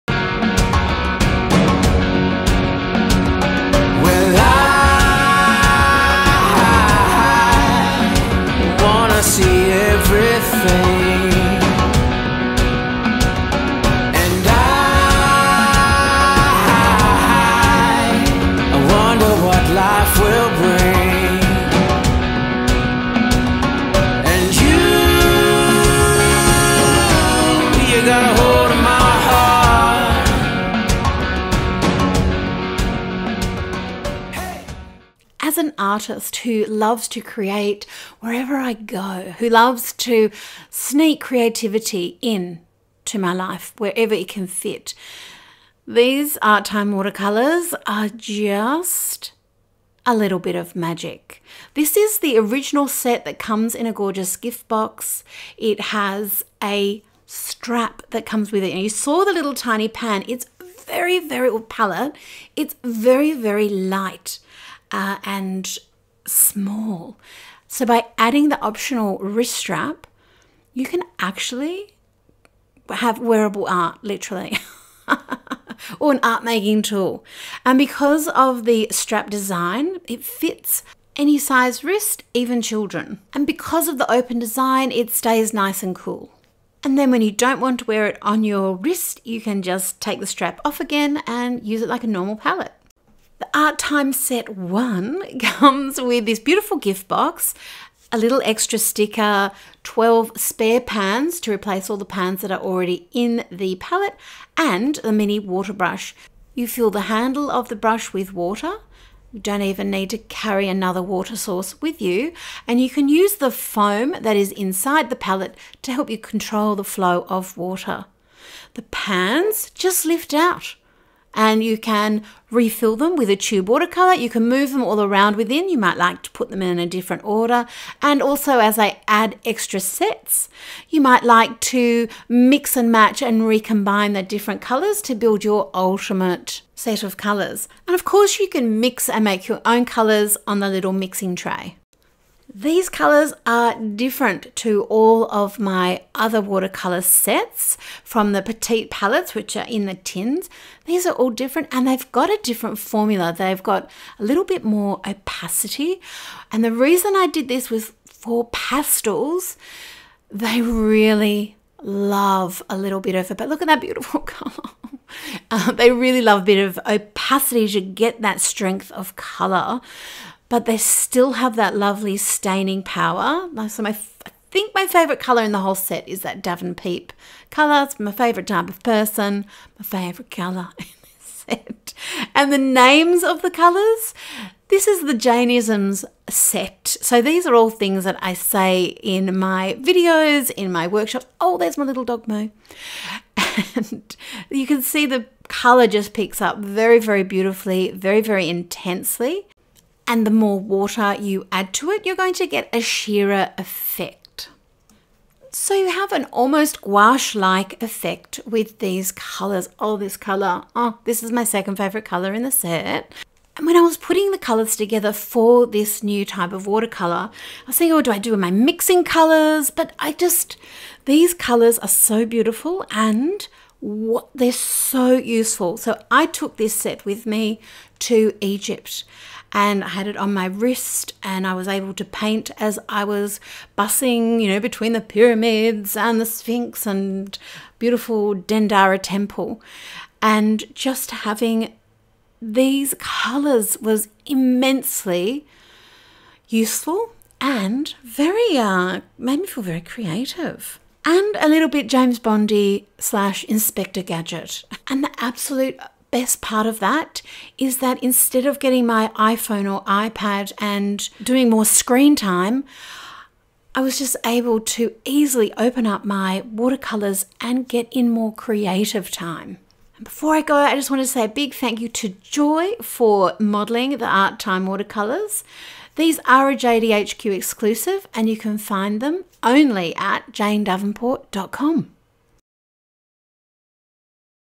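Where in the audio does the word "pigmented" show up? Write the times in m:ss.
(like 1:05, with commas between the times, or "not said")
not said.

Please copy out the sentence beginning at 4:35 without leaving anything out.
These are a JDHQ exclusive and you can find them only at janedavenport.com.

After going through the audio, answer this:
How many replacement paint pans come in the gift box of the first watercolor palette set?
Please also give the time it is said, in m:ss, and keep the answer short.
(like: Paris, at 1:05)
12, at 1:39.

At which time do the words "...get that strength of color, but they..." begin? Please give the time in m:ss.
2:47.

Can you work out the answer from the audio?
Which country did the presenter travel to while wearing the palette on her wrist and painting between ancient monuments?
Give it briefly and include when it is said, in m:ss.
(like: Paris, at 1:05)
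Egypt, at 3:48.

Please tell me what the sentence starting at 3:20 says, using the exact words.
And the more water you add to it, you're going to get a sheerer effect.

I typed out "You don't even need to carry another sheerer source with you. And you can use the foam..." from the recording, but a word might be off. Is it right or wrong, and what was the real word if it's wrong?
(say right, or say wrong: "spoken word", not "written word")
wrong: "water", not "sheerer".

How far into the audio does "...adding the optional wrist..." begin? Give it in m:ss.
1:08.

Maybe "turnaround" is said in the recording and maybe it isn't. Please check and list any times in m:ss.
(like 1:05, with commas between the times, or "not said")
not said.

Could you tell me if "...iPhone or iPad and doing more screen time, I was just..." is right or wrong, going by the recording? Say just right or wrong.
right.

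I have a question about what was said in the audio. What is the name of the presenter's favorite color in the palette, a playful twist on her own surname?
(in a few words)
Davenpeep.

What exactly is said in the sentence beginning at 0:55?
It has a strap that comes with it.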